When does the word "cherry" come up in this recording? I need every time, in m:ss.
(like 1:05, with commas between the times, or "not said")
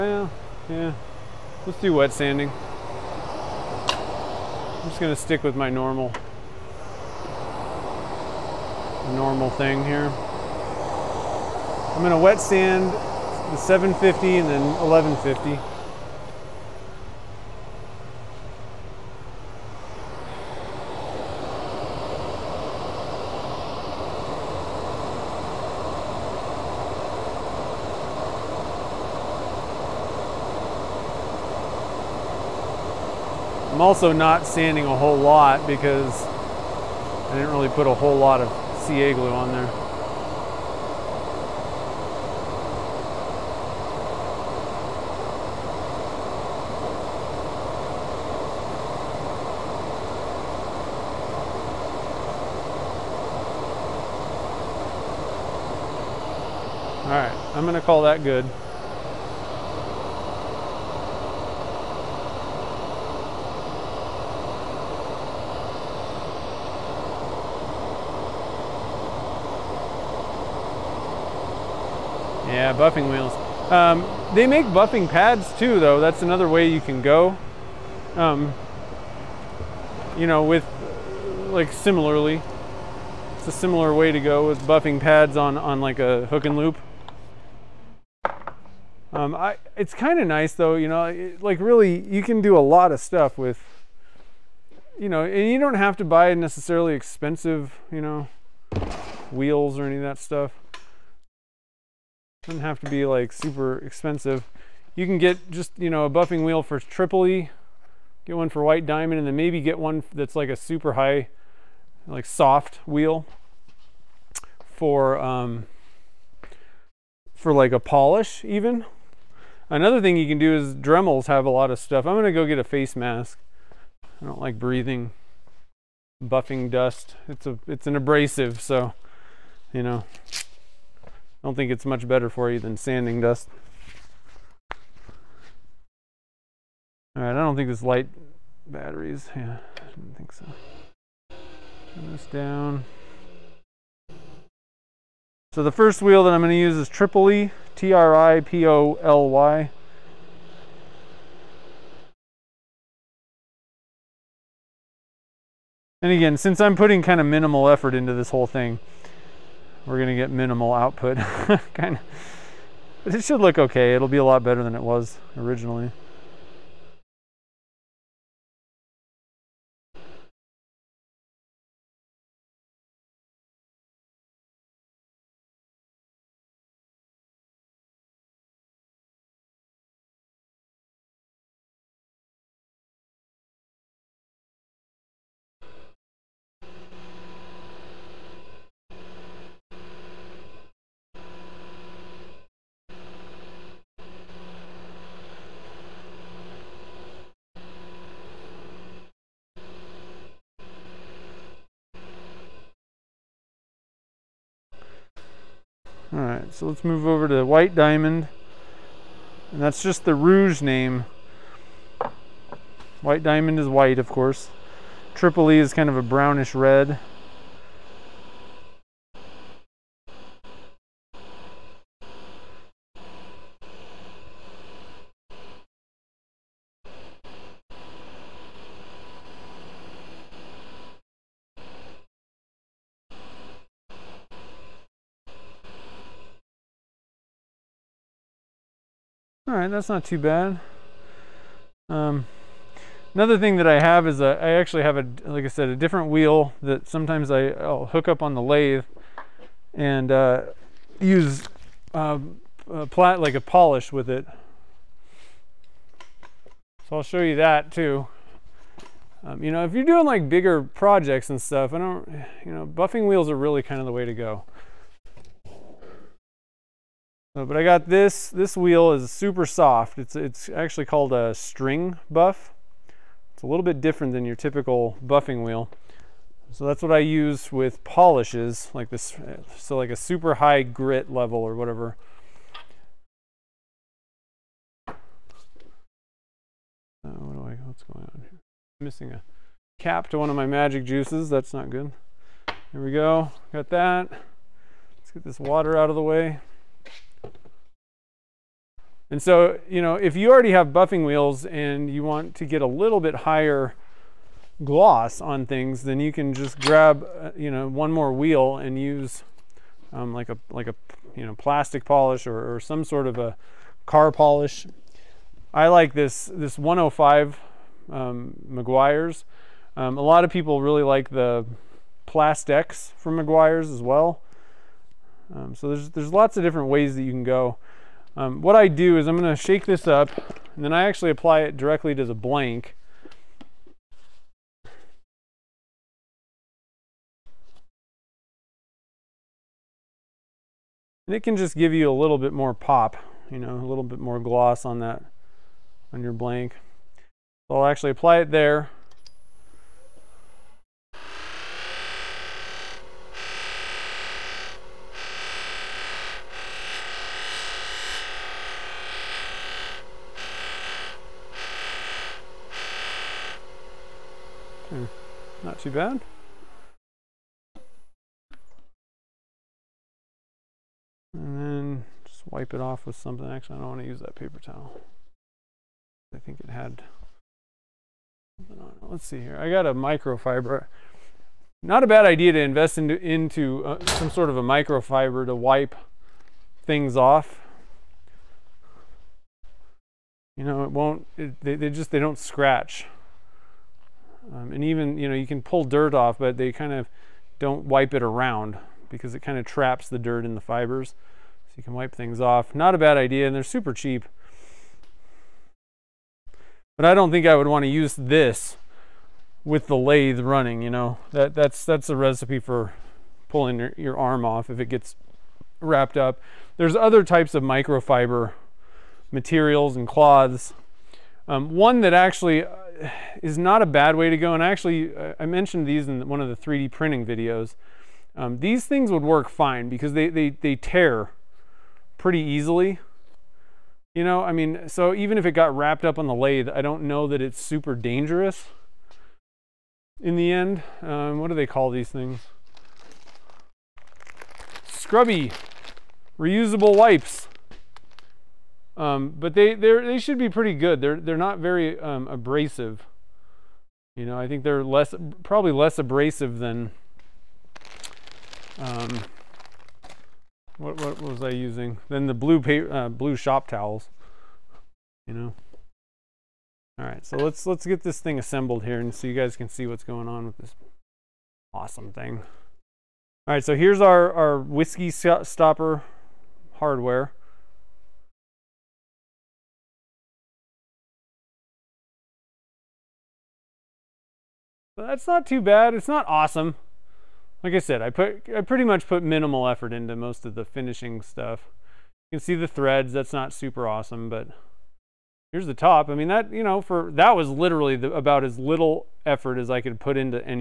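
not said.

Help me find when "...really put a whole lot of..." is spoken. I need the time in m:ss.
0:37.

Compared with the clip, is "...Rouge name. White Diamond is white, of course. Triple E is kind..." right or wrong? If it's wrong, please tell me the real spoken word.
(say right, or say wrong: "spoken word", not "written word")
right.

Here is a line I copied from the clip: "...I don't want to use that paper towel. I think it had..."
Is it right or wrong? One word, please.
right.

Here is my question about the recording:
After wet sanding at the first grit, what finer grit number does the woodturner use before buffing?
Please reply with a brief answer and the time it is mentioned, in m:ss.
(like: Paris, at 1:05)
1150, at 0:14.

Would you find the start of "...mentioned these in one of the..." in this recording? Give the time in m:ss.
7:05.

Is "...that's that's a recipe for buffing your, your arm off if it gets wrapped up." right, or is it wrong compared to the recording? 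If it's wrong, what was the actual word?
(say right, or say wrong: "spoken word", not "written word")
wrong: "pulling", not "buffing".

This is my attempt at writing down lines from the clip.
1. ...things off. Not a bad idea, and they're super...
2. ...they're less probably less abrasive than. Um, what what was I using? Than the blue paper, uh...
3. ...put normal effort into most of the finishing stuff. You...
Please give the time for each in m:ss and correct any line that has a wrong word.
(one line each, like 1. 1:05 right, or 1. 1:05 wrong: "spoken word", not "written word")
1. 6:41 right
2. 7:34 right
3. 8:08 wrong: "minimal", not "normal".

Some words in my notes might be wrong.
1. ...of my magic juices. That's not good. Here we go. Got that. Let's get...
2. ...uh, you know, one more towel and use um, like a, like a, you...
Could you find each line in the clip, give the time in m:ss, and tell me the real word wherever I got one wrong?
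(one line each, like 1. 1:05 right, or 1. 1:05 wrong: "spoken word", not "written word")
1. 4:50 right
2. 5:07 wrong: "wheel", not "towel".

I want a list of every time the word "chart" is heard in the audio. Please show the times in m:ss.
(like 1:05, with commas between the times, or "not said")
not said.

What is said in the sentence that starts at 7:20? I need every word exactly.
Um, what do they call these things?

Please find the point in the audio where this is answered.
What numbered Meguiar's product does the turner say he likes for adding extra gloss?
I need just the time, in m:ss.
5:16.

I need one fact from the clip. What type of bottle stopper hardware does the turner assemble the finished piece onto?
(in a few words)
whiskey stopper.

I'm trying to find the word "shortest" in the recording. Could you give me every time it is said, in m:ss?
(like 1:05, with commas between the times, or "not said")
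not said.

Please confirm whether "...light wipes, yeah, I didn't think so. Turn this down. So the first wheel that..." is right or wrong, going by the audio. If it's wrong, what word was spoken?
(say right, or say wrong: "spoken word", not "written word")
wrong: "batteries", not "wipes".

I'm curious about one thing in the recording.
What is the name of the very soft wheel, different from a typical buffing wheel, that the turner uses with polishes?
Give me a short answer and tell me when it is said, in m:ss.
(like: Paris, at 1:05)
string buff, at 4:31.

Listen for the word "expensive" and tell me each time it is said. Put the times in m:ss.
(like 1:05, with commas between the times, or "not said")
1:36, 1:43.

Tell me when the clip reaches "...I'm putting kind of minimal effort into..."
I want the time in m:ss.
2:36.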